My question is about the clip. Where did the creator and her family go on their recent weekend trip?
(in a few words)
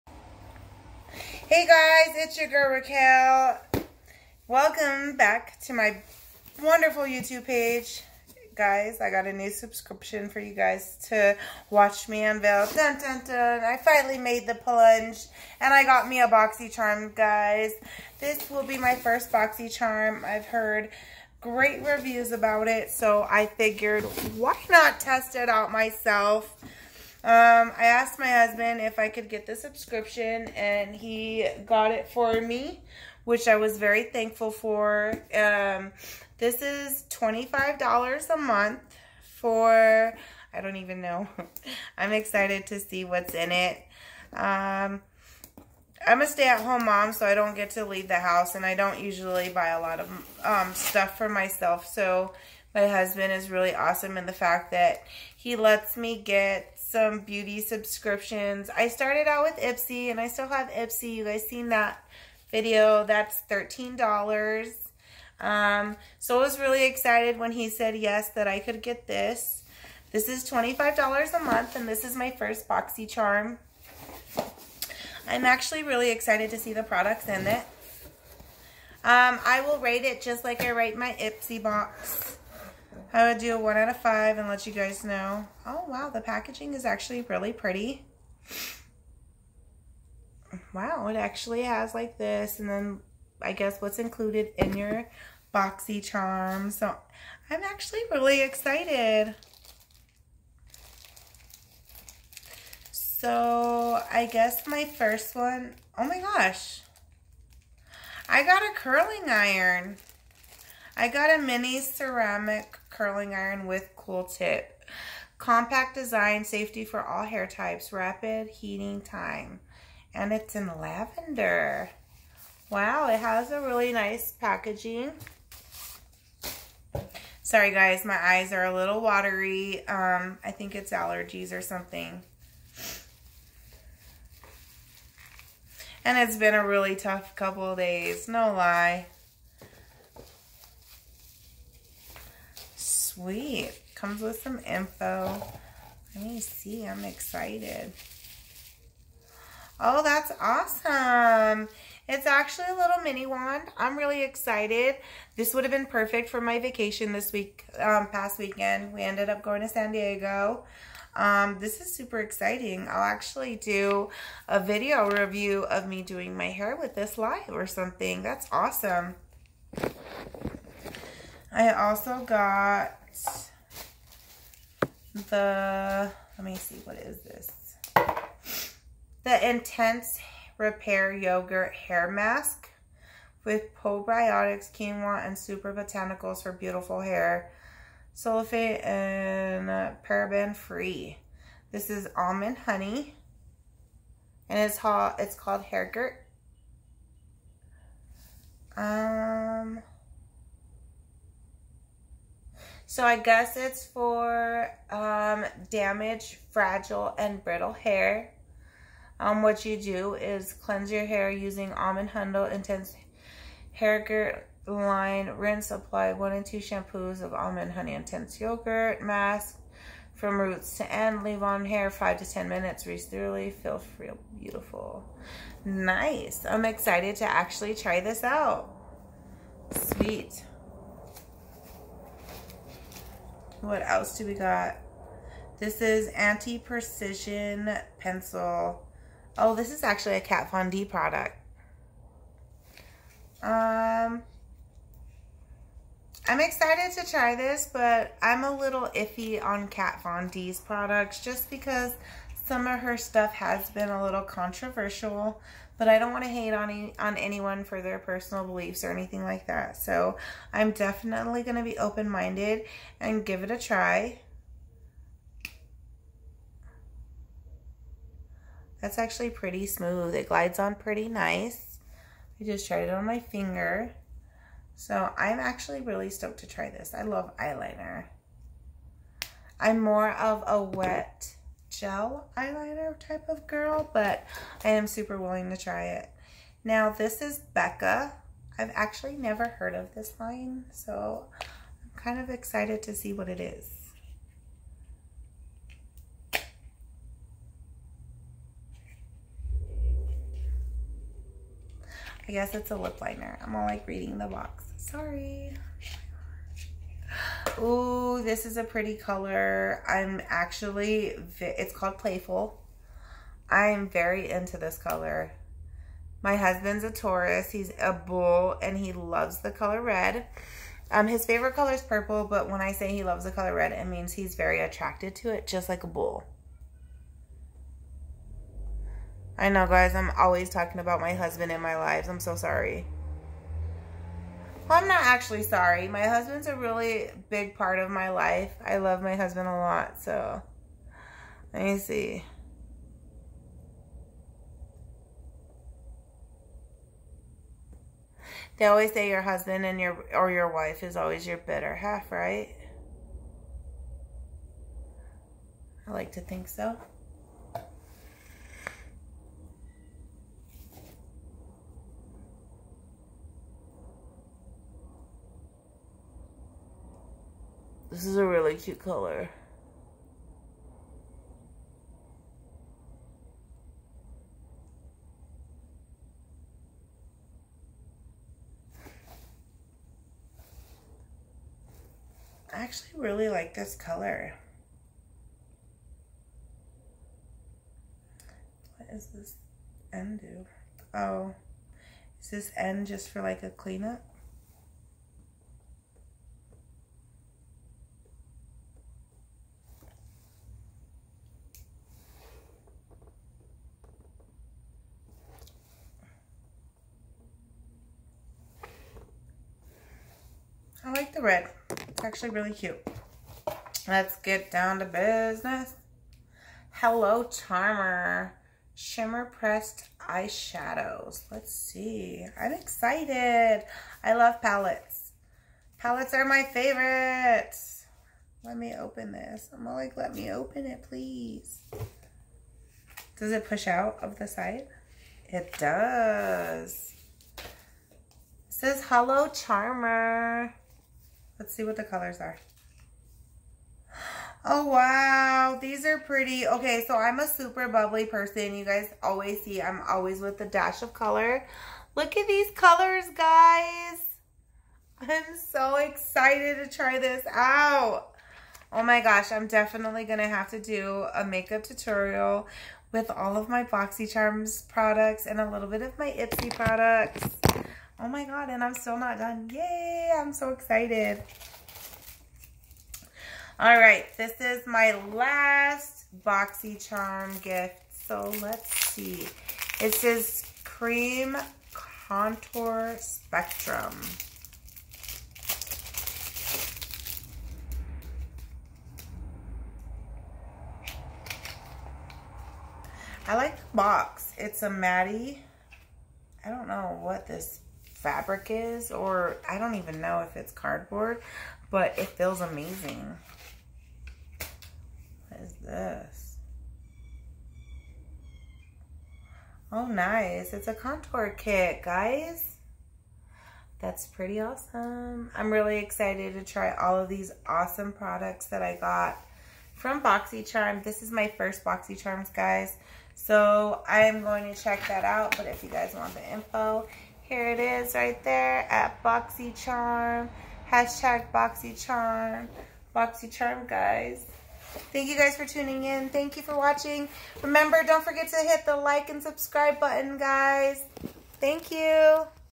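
San Diego.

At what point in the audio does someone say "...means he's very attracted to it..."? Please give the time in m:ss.
5:23.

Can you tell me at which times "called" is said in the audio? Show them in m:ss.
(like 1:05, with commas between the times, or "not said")
3:15, 5:11.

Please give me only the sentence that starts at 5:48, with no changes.
They always say your husband and your or your wife is always your better half, right?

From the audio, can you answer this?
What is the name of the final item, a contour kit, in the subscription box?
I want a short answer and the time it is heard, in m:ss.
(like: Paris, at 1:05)
Cream Contour Spectrum, at 8:00.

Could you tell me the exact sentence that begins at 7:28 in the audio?
You guys always see I'm always with a dash of color.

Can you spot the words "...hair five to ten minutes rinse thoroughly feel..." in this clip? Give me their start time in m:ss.
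3:41.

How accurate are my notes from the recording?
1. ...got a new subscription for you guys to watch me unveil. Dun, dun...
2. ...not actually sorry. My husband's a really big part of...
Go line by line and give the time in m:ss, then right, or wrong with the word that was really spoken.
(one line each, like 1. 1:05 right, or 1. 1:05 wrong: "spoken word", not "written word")
1. 0:09 right
2. 5:34 right.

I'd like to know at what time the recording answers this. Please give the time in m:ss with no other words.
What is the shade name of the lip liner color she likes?
5:11.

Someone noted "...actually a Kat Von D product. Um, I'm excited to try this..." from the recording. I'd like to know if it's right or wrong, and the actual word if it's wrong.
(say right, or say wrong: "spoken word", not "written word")
right.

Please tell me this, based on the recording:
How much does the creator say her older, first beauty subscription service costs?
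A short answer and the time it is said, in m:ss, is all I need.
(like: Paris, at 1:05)
$13, at 1:03.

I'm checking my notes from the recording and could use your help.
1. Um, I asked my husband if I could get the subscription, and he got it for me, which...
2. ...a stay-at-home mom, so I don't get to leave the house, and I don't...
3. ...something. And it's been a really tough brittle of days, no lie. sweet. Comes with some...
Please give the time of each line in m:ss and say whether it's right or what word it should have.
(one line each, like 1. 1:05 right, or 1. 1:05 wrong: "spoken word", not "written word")
1. 0:27 right
2. 0:46 right
3. 2:11 wrong: "couple", not "brittle".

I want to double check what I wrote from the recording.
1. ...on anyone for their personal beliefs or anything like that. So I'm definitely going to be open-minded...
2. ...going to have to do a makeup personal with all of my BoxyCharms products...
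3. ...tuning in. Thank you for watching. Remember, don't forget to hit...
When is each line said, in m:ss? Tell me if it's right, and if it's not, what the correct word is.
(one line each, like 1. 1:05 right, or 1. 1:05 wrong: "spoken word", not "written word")
1. 4:16 right
2. 7:40 wrong: "tutorial", not "personal"
3. 8:55 right.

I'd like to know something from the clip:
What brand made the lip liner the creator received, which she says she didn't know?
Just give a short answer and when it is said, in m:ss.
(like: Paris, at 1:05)
Becca, at 4:47.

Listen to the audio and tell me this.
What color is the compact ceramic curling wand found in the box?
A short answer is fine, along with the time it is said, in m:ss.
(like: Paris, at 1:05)
lavender, at 2:00.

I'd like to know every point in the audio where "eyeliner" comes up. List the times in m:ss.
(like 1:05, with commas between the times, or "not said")
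4:37, 4:42.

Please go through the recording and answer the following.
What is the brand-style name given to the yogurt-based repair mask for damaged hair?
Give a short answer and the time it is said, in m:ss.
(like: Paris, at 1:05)
Hair Gurt, at 3:15.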